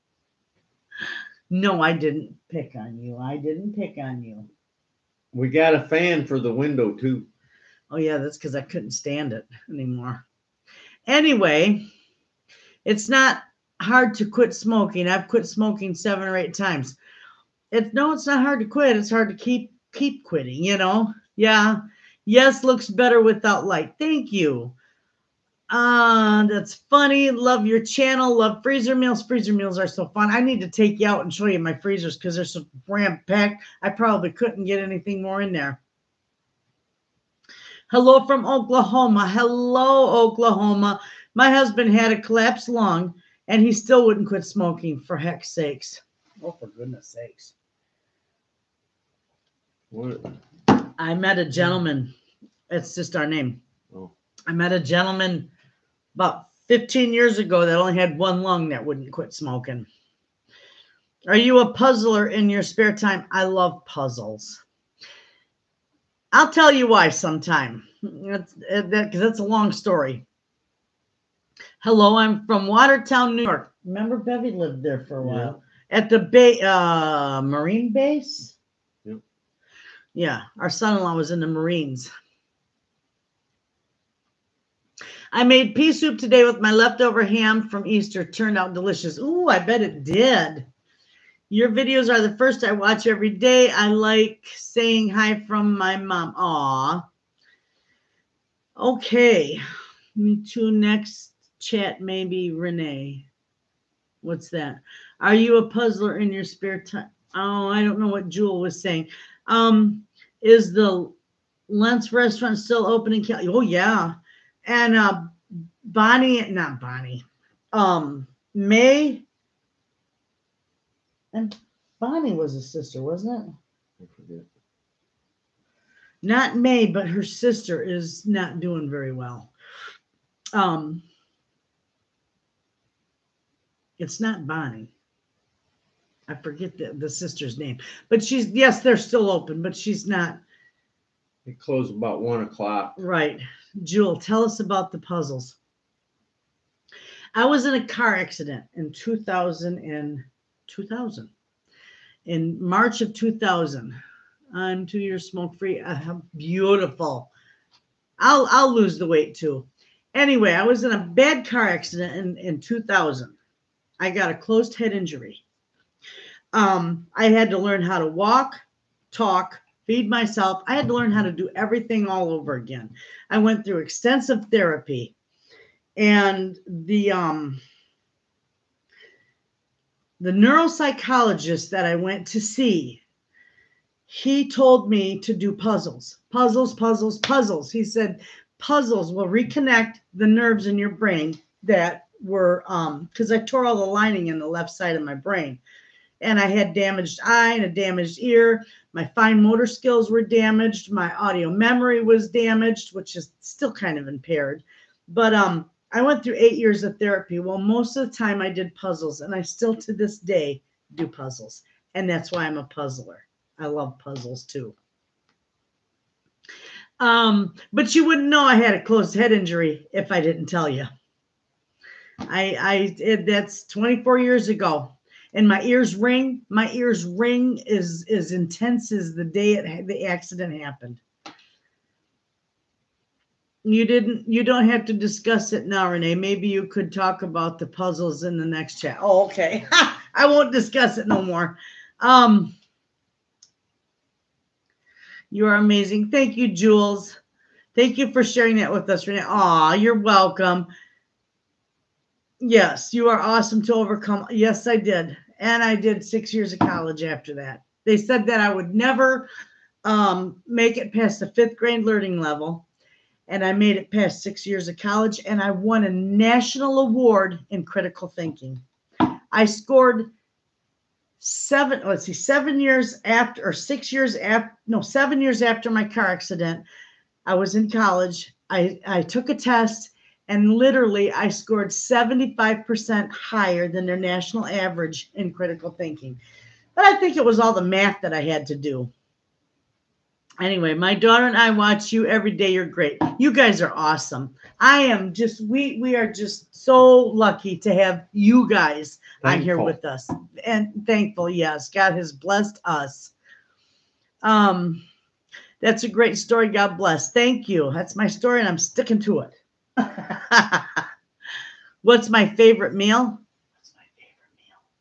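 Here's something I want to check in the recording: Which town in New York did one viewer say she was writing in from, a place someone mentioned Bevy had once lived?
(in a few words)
Watertown.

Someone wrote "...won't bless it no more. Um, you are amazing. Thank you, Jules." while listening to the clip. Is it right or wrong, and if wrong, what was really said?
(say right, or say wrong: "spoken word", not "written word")
wrong: "discuss", not "bless".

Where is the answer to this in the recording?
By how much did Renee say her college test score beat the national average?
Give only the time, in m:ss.
4:41.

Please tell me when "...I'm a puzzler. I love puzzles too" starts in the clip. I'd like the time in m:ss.
3:32.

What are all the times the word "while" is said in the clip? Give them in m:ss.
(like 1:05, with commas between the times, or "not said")
1:15.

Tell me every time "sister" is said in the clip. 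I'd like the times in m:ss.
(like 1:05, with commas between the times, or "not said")
2:02, 2:07, 2:17.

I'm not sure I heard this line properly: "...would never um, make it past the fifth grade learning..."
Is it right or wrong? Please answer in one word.
right.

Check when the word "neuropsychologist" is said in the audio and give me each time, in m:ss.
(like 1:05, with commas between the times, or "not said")
3:00.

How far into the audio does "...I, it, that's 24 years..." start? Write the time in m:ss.
3:42.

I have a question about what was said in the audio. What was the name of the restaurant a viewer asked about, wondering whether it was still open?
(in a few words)
Lentz.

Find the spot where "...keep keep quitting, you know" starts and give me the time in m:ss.
0:19.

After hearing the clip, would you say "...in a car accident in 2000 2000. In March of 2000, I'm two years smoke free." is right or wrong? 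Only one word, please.
right.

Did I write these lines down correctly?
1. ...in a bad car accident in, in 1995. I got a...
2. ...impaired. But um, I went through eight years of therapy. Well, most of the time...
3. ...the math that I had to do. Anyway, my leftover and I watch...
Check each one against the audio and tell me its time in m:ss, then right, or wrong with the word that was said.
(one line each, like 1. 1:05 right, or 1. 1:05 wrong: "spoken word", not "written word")
1. 2:40 wrong: "2000", not "1995"
2. 3:24 right
3. 4:47 wrong: "daughter", not "leftover".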